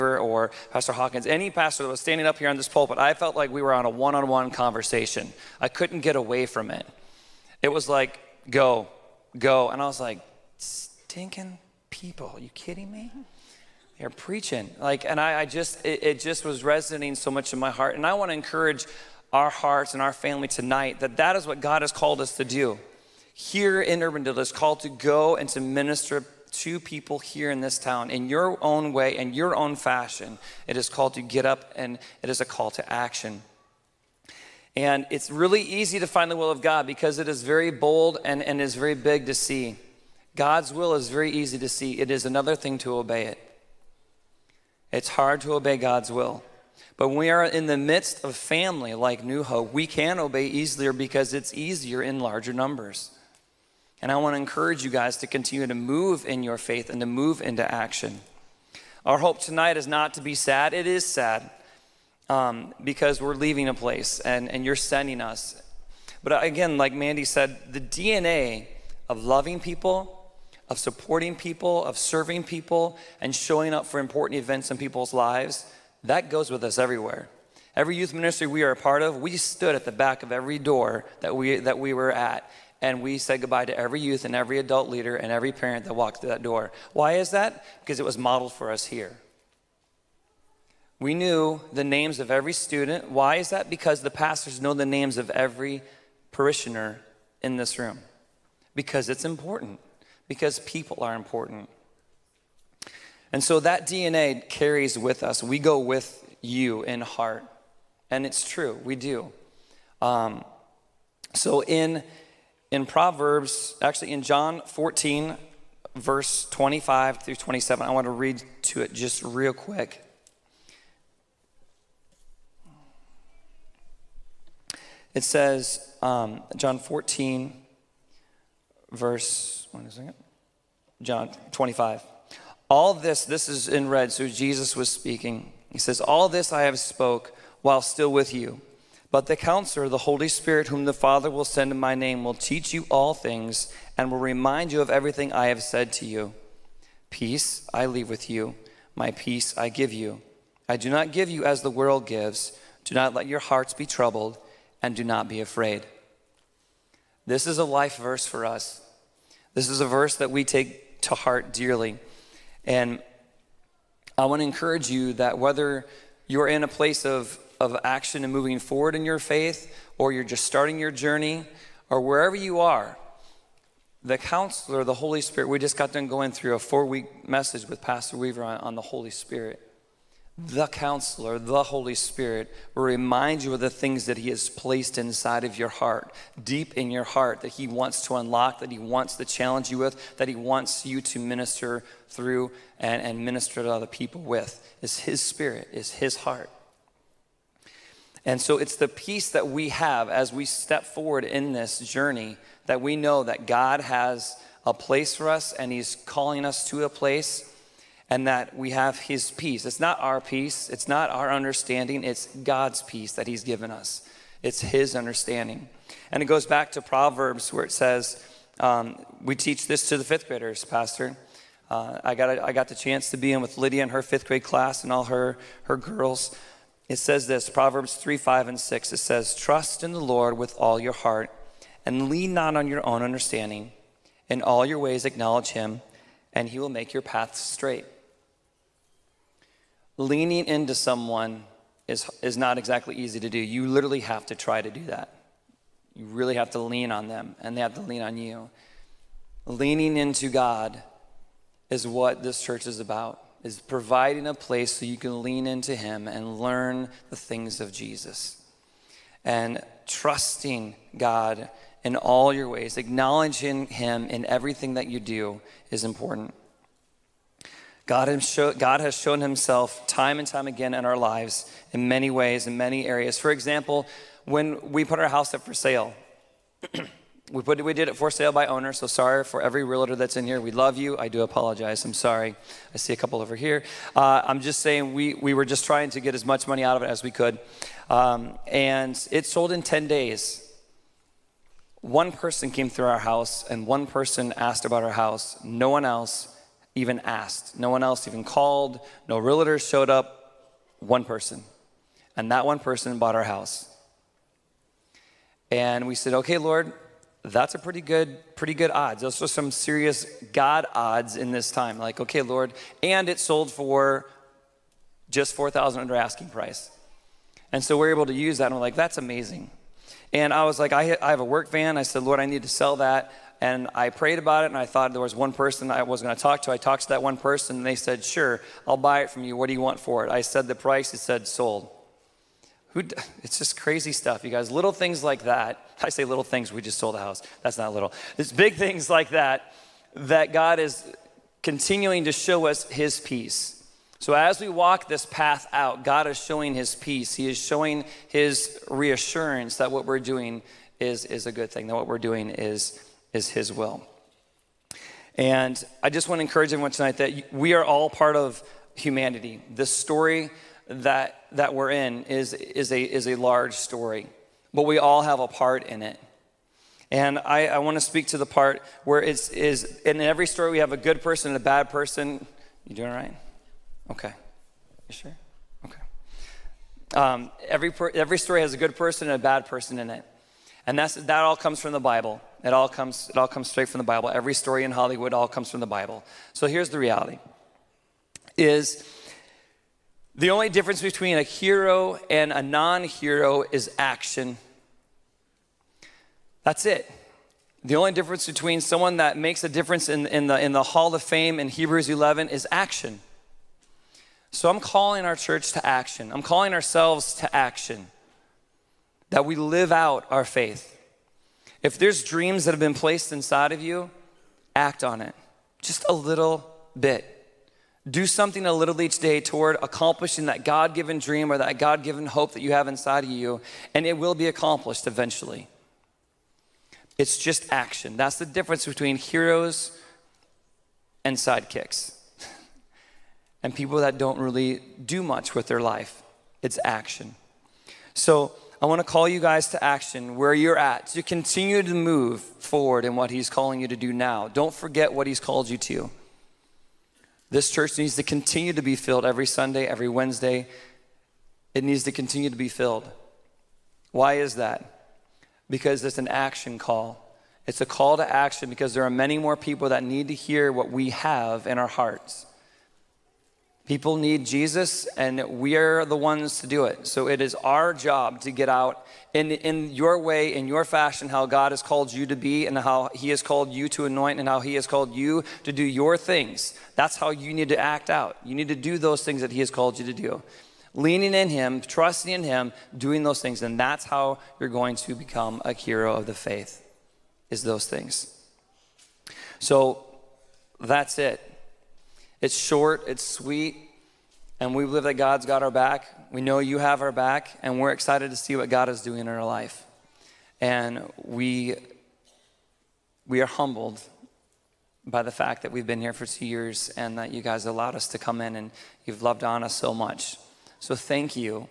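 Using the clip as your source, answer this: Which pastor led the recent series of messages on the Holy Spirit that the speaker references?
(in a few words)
Pastor Weaver.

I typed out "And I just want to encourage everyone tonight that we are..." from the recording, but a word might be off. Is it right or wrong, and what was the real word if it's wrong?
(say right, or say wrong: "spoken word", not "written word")
right.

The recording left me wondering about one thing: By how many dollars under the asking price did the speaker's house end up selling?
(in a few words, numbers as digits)
4,000.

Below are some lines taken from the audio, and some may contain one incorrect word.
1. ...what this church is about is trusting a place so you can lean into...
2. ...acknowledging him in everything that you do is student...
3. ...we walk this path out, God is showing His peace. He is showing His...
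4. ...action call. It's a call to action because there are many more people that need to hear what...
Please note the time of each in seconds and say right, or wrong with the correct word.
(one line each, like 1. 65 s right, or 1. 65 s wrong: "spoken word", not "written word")
1. 251 s wrong: "providing", not "trusting"
2. 262 s wrong: "important", not "student"
3. 344 s right
4. 456 s right.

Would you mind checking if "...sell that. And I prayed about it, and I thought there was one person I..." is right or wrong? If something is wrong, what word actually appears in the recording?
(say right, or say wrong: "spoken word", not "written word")
right.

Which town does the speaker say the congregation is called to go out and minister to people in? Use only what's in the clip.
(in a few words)
Urbandale.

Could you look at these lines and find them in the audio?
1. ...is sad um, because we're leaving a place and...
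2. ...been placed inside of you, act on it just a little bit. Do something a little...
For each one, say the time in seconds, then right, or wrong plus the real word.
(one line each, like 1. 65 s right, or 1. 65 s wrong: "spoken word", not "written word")
1. 60 s right
2. 412 s right.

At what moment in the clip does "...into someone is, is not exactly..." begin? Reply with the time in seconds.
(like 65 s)
240 s.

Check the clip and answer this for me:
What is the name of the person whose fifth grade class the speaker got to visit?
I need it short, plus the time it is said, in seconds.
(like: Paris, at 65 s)
Lydia, at 223 s.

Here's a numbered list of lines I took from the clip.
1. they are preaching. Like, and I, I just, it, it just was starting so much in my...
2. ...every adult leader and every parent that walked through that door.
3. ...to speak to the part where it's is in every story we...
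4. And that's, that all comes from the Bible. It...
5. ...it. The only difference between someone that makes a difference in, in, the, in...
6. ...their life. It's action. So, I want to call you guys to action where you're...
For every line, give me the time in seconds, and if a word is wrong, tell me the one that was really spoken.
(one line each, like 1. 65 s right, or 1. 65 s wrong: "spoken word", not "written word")
1. 13 s wrong: "resonating", not "starting"
2. 84 s right
3. 367 s right
4. 380 s right
5. 396 s right
6. 435 s right.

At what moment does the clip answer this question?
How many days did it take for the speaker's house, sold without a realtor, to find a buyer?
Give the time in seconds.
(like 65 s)
289 s.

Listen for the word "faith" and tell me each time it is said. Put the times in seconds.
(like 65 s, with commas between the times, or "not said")
56 s, 169 s, 410 s, 486 s.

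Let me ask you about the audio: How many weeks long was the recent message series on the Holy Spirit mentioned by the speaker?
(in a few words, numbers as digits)
4.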